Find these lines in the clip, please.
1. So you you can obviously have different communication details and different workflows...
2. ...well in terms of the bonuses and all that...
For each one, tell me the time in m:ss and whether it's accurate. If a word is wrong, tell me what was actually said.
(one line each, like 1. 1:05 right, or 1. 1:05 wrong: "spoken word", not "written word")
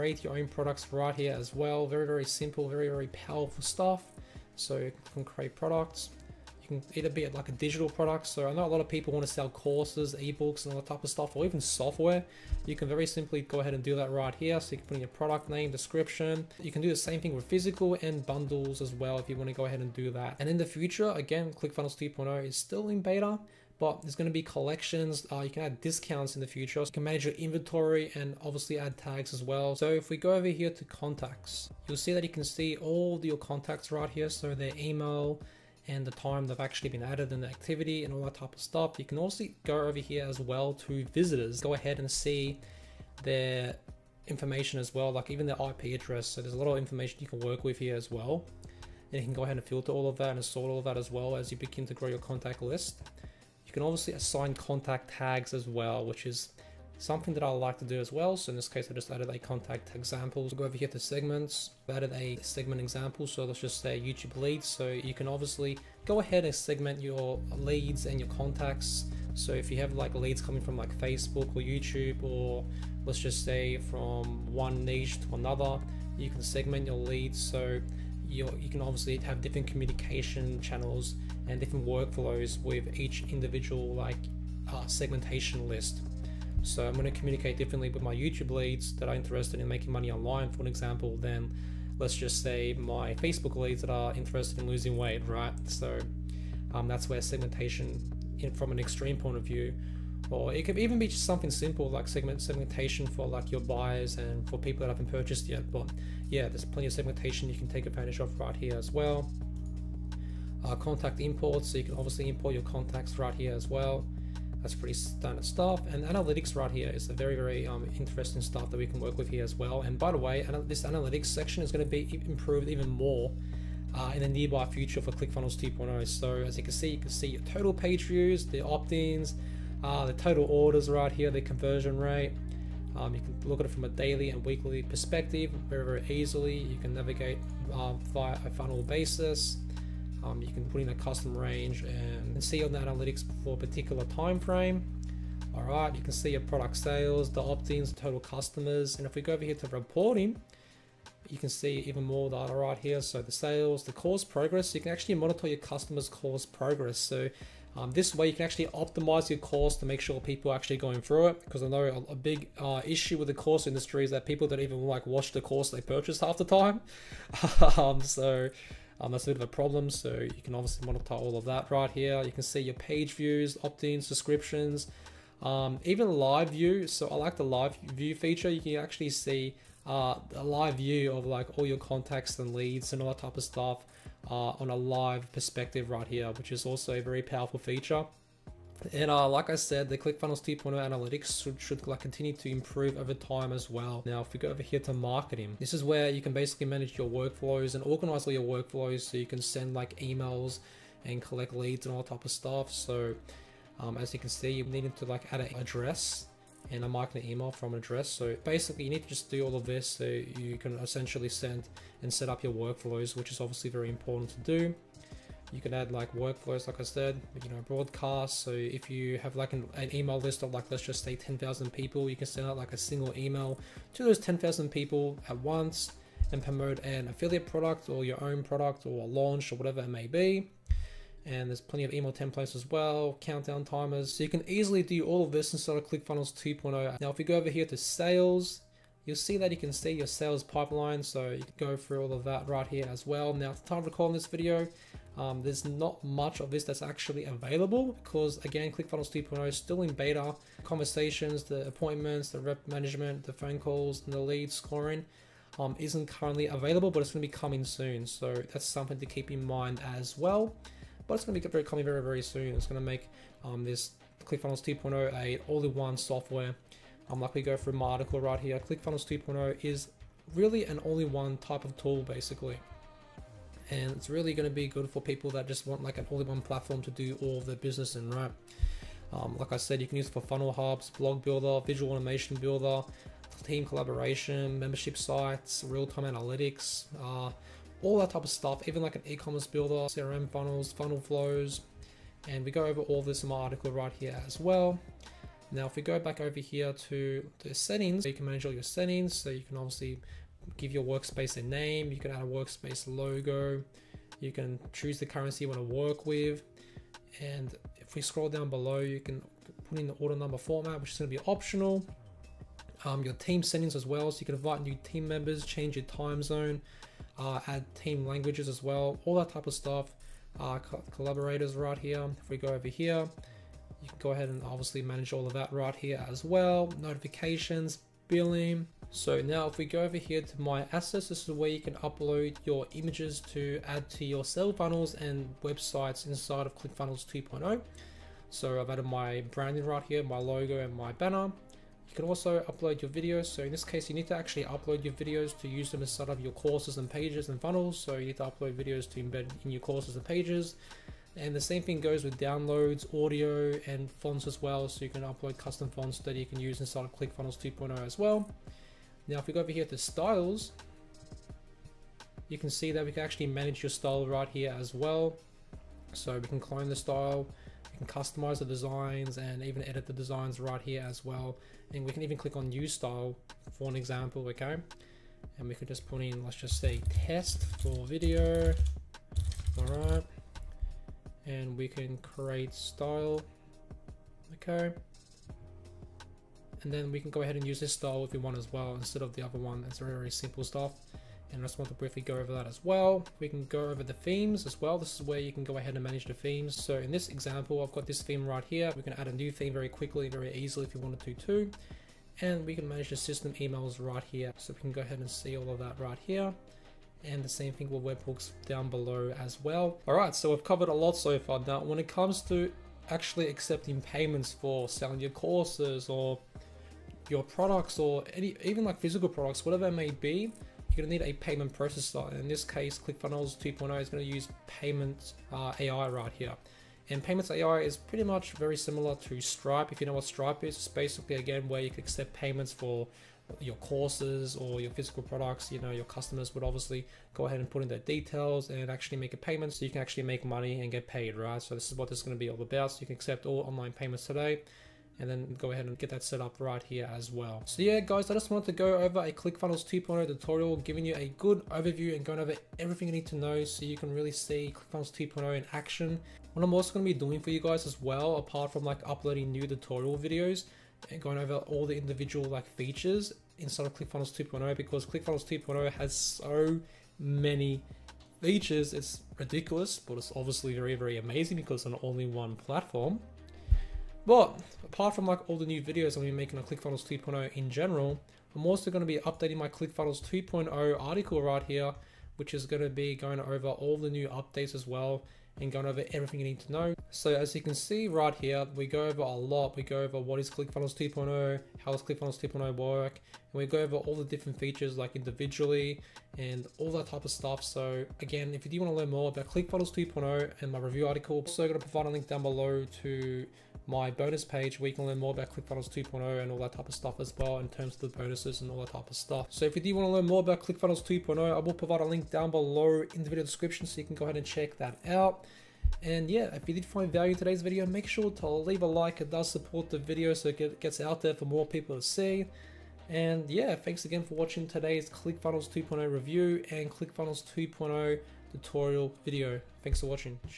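1. 1:17 wrong: "channels", not "details"
2. 8:27 right.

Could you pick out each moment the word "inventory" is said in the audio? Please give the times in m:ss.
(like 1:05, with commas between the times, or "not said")
0:27.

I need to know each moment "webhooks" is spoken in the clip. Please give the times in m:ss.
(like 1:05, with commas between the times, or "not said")
6:47.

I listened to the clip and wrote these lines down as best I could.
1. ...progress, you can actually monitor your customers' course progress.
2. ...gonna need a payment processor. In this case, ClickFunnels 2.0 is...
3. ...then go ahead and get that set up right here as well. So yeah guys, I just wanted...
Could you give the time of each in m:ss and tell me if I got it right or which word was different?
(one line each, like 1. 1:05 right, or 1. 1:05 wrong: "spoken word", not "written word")
1. 2:34 right
2. 7:00 right
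3. 7:25 right.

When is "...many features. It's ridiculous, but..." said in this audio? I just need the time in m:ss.
7:46.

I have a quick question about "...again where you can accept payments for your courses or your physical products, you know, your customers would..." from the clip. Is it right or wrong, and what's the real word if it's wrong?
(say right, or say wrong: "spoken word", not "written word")
right.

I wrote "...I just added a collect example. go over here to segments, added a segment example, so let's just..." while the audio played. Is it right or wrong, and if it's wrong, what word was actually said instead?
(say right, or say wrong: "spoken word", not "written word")
wrong: "contact", not "collect".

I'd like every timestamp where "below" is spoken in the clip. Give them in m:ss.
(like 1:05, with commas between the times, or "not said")
5:08, 6:48, 8:22, 8:32.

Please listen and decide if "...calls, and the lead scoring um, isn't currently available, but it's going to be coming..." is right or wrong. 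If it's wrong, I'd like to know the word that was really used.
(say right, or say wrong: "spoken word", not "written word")
right.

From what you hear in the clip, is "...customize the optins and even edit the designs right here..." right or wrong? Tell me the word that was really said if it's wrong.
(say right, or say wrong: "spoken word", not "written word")
wrong: "designs", not "optins".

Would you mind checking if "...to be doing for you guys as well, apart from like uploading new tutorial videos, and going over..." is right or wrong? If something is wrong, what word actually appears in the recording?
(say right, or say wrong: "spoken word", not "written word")
right.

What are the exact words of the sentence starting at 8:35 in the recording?
And yeah, if you did find value in today's video, make sure to leave a like.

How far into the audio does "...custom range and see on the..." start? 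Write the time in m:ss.
2:20.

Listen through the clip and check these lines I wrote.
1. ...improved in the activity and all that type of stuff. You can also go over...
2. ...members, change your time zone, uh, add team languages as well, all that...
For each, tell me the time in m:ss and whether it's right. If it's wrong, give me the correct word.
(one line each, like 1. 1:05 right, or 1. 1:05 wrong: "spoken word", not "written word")
1. 0:37 wrong: "added", not "improved"
2. 5:15 right.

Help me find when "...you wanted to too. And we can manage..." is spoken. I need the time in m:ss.
6:40.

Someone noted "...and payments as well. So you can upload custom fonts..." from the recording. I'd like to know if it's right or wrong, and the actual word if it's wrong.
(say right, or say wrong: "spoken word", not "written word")
wrong: "fonts", not "payments".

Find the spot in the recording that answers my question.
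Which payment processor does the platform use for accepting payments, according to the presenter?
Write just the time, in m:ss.
7:07.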